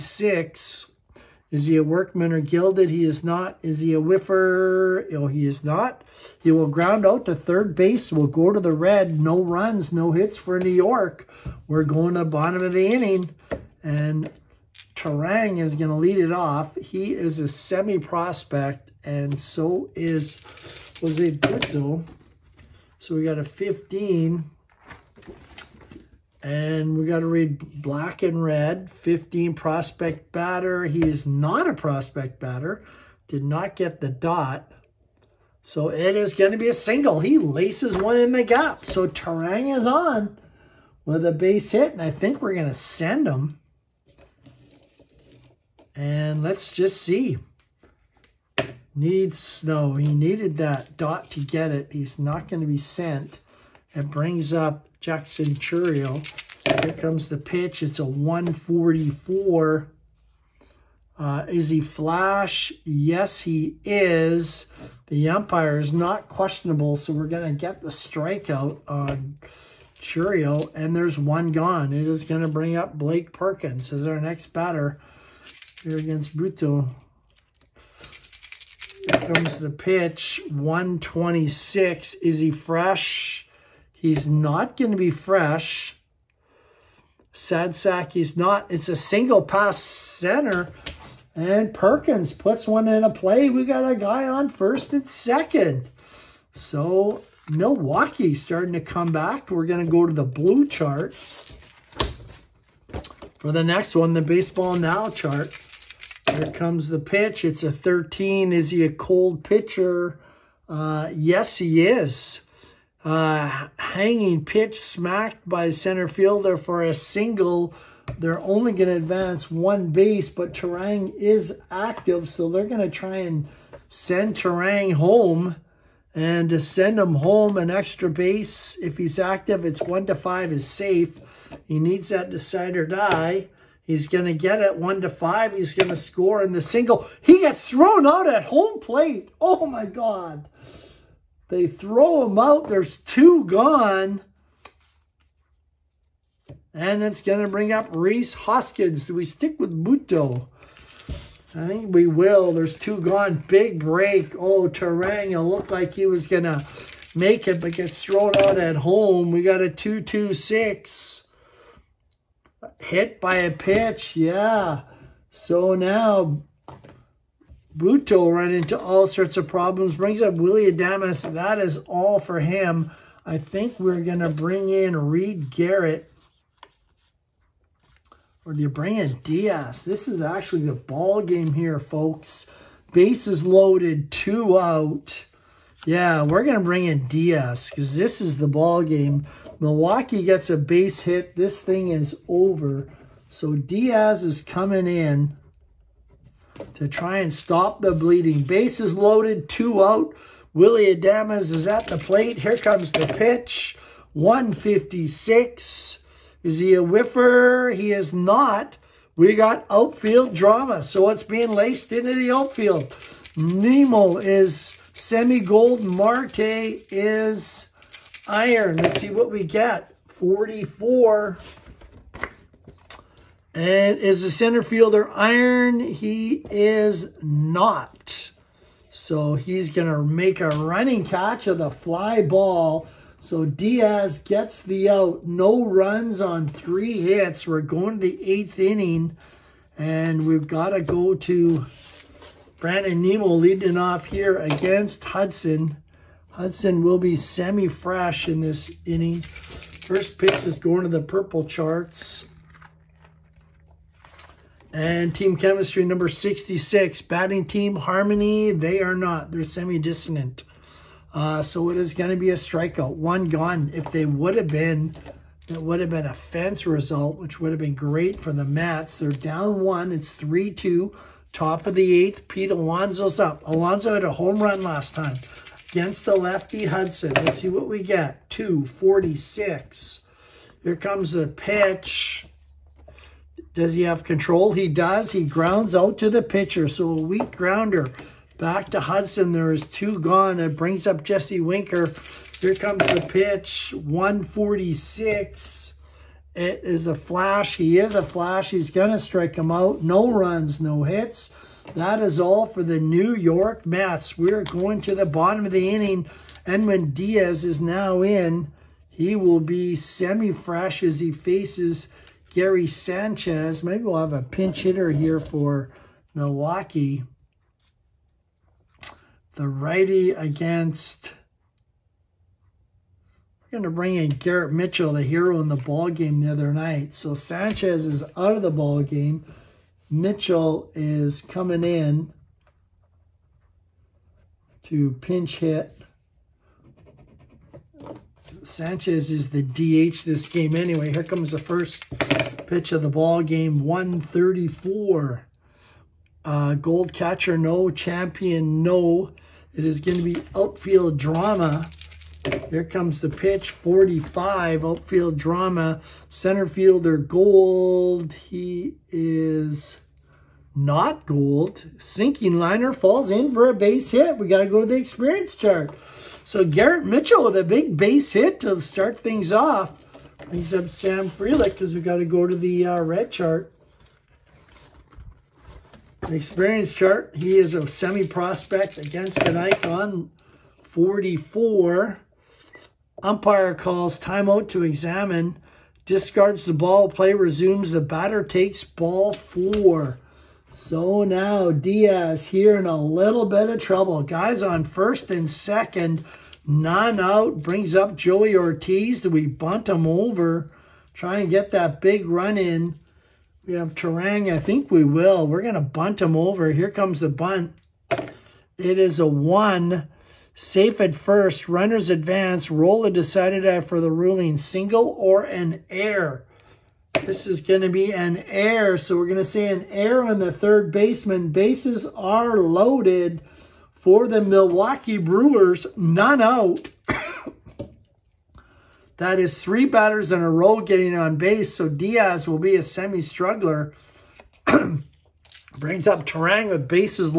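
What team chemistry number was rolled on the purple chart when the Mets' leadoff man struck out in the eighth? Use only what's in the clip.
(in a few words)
66.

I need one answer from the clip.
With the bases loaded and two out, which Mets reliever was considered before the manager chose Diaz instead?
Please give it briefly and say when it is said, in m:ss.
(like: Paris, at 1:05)
Reed Garrett, at 2:54.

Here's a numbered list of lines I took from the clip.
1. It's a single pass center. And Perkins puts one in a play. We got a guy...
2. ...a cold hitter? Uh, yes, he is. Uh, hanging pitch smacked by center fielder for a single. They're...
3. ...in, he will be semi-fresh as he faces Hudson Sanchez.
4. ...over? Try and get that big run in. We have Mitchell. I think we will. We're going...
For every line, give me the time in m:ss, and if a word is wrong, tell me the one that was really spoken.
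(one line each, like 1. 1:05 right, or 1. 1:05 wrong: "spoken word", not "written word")
1. 1:28 right
2. 1:48 wrong: "pitcher", not "hitter"
3. 5:08 wrong: "Gary", not "Hudson"
4. 6:39 wrong: "Turang", not "Mitchell".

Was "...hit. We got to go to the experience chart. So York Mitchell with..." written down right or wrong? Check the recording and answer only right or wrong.
wrong.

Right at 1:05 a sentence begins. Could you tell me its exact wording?
The umpire is not questionable, so we're going to get the strikeout on Churio, and there's one gone.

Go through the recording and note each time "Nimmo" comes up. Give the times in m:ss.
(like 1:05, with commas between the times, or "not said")
3:33, 4:03.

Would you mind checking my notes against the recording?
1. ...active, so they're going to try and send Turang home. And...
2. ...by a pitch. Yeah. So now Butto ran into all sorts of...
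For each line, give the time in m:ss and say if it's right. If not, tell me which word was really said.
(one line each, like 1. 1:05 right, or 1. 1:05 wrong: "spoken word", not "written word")
1. 2:01 right
2. 2:43 right.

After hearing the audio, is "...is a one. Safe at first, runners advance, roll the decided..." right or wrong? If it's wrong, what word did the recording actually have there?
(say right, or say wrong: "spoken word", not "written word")
right.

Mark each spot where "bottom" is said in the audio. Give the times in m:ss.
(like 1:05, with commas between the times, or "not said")
0:12, 5:05.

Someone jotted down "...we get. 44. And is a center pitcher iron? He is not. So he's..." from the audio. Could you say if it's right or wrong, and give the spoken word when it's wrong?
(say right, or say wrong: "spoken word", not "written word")
wrong: "fielder", not "pitcher".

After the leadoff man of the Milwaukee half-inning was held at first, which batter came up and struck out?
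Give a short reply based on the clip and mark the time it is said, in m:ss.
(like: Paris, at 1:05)
Jackson Chourio, at 0:55.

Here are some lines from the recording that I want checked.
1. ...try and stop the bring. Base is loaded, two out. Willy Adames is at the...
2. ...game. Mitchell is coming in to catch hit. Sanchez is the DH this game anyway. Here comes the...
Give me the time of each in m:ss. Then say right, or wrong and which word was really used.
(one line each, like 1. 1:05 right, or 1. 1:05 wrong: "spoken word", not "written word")
1. 3:16 wrong: "bleeding", not "bring"
2. 5:28 wrong: "pinch", not "catch".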